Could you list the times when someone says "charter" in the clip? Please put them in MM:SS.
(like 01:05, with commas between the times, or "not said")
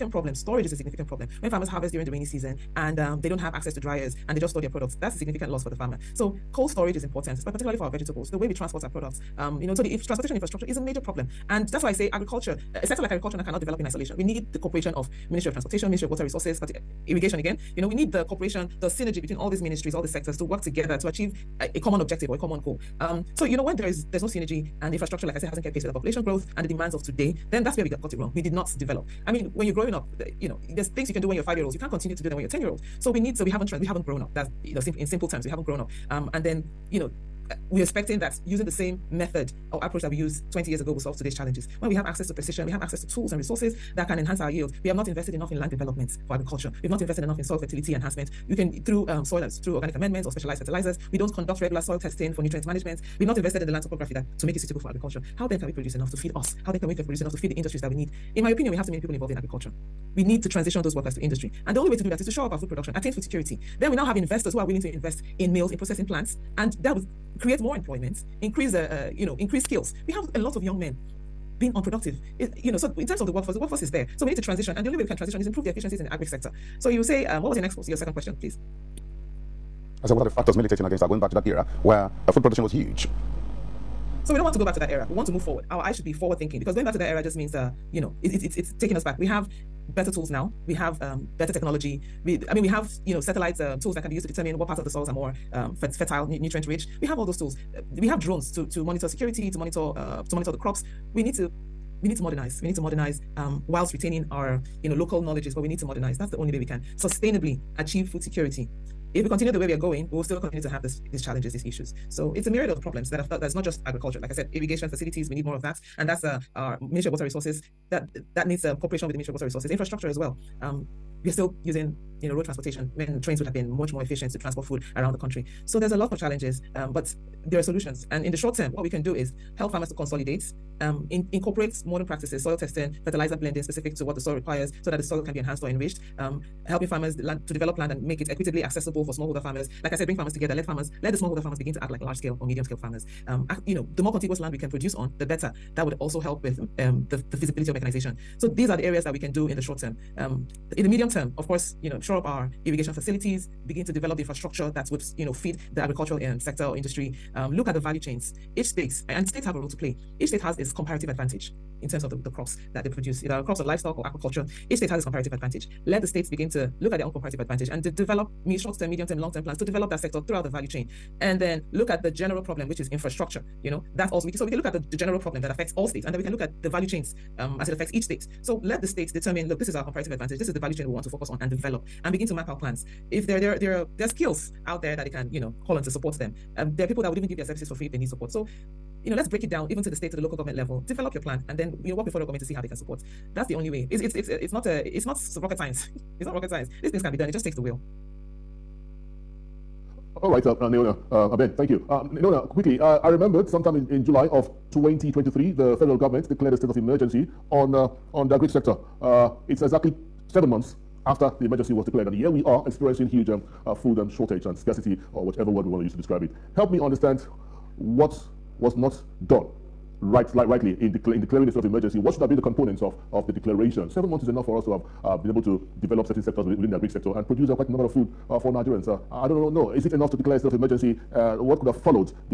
not said.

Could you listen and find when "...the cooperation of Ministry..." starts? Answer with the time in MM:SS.
00:14.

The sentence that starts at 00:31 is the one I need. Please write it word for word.
You can't continue to do them when you're ten year old.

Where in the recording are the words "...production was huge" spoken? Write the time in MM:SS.
01:22.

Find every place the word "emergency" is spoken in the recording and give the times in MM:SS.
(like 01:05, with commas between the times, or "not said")
03:26, 03:31, 03:41, 03:50.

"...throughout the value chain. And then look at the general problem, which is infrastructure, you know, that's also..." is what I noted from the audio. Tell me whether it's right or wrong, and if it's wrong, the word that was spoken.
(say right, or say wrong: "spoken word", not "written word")
right.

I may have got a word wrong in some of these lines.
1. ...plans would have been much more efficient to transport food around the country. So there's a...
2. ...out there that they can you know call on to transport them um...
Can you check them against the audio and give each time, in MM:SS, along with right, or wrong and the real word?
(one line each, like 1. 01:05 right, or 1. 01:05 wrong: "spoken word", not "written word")
1. 02:03 wrong: "trains", not "plans"
2. 03:04 wrong: "support", not "transport".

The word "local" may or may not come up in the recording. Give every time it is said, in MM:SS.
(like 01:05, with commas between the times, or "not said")
01:44, 03:10.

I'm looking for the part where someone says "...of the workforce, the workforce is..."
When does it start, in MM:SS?
01:13.